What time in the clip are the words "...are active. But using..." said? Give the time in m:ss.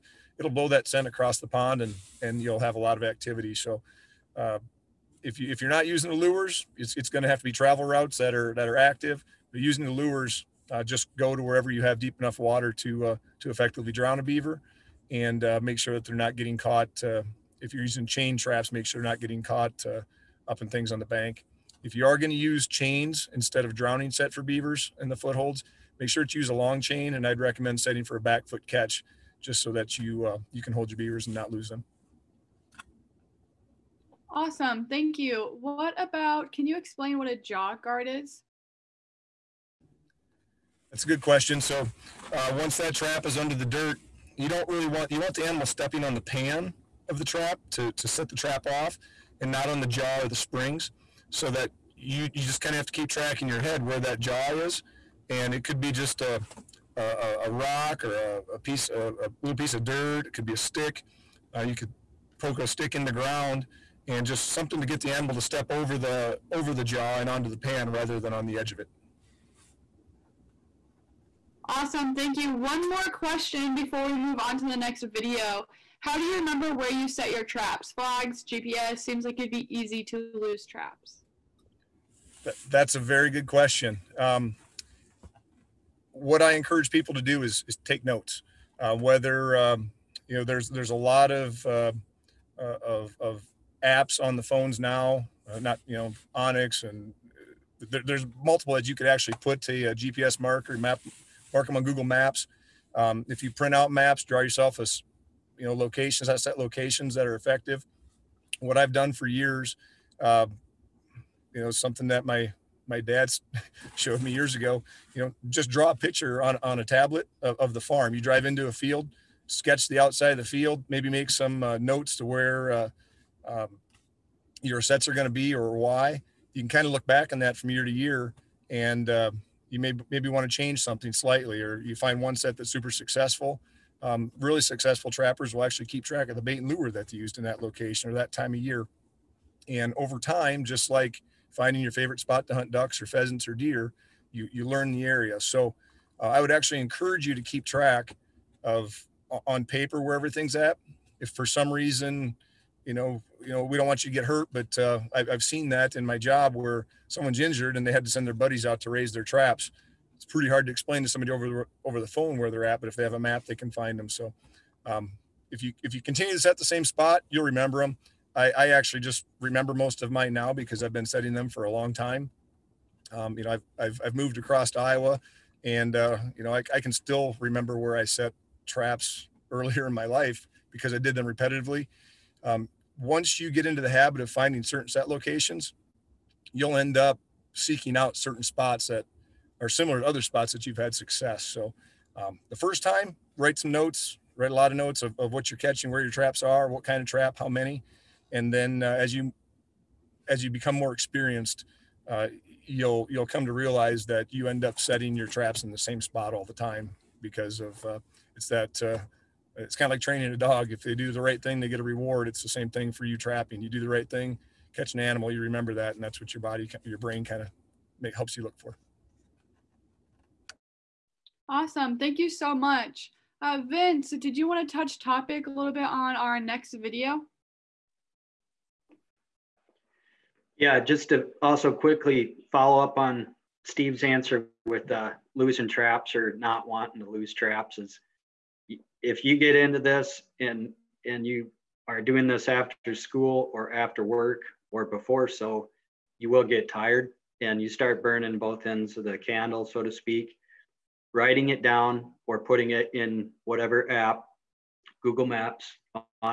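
0:08.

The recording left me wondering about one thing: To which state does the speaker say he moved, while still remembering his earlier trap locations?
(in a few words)
Iowa.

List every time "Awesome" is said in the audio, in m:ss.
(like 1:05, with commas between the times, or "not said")
0:34, 1:11, 3:41.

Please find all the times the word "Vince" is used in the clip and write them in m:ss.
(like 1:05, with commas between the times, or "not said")
3:43.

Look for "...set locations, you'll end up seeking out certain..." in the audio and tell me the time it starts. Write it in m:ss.
3:04.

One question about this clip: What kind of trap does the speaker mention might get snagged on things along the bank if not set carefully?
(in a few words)
Chain traps.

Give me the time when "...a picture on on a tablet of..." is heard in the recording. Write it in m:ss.
1:55.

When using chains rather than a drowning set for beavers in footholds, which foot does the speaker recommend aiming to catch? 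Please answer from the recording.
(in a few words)
Back foot.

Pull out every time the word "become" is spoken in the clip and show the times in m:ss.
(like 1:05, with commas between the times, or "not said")
3:20.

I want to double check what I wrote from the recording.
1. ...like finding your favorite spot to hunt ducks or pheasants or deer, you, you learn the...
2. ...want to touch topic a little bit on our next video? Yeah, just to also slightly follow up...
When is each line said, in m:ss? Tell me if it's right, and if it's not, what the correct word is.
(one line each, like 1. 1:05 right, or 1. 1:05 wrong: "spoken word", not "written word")
1. 2:20 right
2. 3:44 wrong: "quickly", not "slightly".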